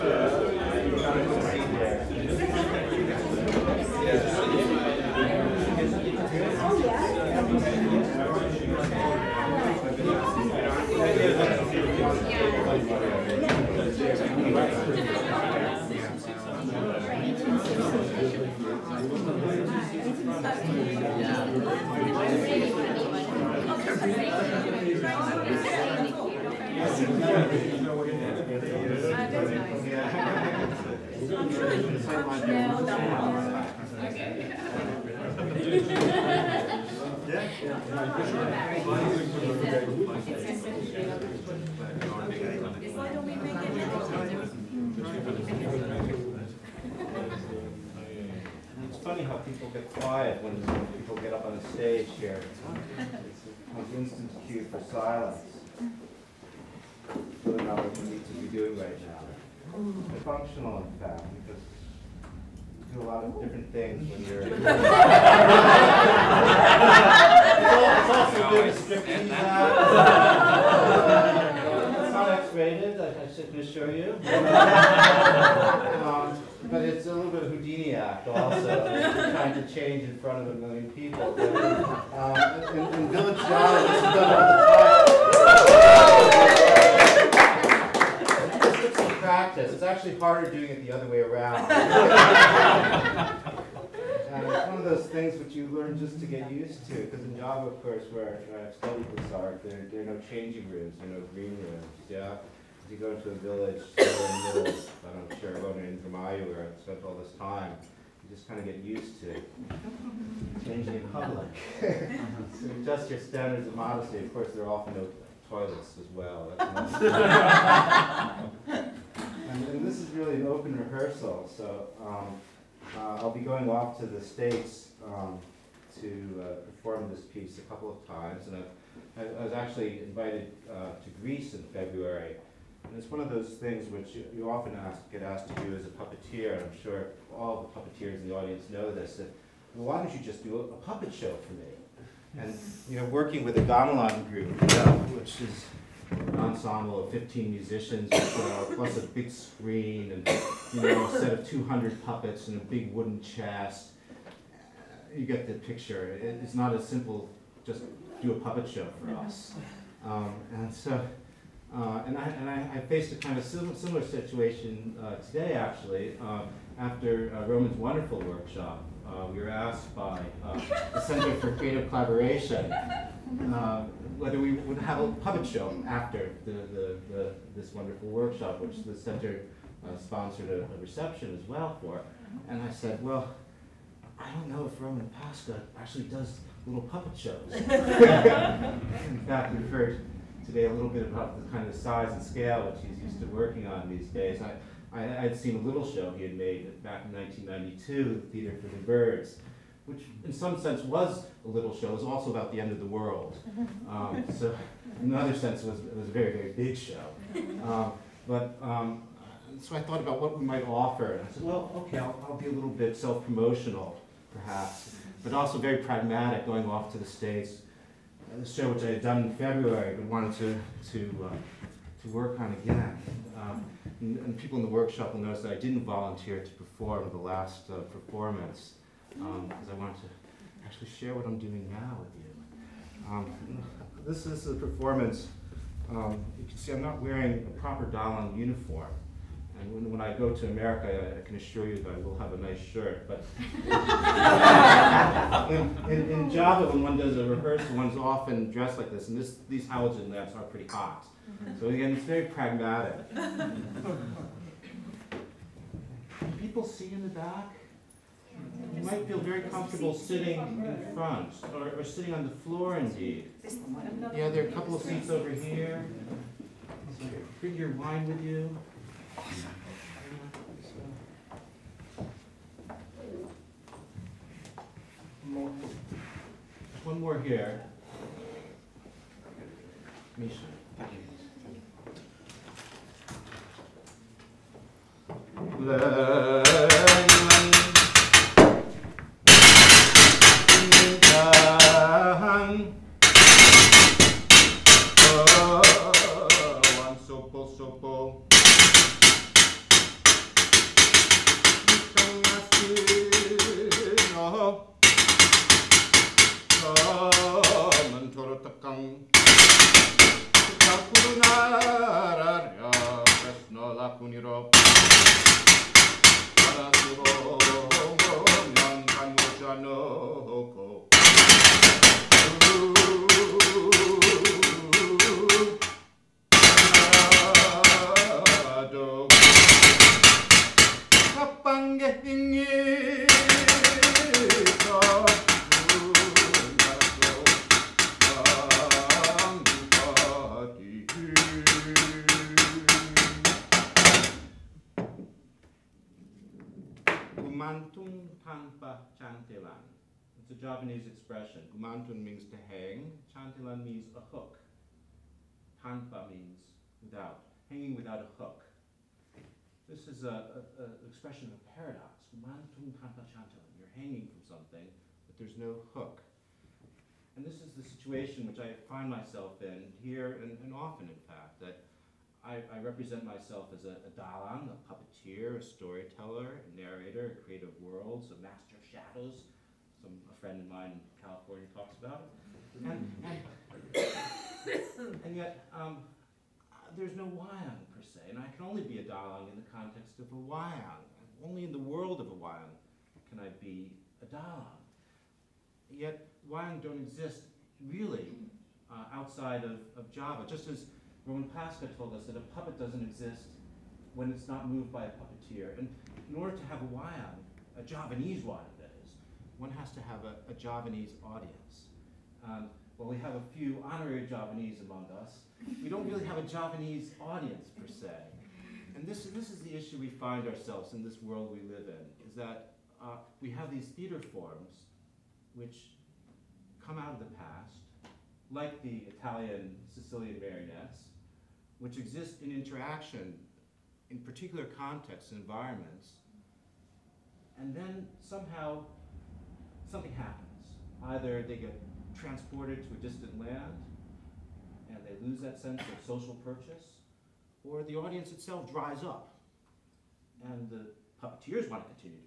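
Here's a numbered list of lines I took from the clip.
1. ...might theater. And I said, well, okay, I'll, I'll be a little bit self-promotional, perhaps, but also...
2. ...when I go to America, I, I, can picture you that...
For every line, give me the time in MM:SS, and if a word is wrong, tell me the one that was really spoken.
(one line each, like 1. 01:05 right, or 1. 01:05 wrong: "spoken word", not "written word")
1. 03:30 wrong: "offer", not "theater"
2. 03:59 wrong: "assure", not "picture".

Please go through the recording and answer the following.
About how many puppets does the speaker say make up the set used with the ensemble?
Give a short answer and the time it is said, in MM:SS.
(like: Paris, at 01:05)
200, at 02:31.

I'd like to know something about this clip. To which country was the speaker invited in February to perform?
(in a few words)
Greece.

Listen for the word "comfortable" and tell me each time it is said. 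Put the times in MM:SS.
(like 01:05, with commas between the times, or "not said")
04:19.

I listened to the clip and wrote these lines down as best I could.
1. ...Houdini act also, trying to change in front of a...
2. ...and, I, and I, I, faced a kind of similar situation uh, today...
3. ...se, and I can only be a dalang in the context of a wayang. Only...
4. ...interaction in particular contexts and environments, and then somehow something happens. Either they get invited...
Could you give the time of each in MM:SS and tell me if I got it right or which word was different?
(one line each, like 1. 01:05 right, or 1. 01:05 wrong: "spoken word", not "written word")
1. 01:17 right
2. 02:42 right
3. 06:27 right
4. 07:12 wrong: "transported", not "invited".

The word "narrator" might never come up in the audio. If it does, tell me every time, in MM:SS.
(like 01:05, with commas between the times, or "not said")
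06:16.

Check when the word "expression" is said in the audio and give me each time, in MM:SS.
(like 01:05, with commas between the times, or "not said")
05:50, 06:00.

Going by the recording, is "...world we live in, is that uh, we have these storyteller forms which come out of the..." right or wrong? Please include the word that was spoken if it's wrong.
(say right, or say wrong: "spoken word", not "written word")
wrong: "theater", not "storyteller".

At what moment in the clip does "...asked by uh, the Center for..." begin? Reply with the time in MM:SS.
02:49.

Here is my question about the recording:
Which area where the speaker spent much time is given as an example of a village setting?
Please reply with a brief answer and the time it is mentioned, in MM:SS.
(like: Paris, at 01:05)
Indramayu, at 01:45.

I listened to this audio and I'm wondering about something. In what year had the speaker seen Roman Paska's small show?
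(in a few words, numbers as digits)
1992.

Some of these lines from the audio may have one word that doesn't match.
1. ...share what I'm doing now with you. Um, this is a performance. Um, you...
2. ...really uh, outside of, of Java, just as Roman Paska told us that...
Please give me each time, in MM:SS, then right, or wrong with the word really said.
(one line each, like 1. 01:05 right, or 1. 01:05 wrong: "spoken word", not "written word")
1. 03:50 right
2. 06:37 right.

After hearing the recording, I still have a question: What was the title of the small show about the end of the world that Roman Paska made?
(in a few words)
Theater for the Birds.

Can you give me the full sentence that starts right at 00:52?
It's an instant cue for silence.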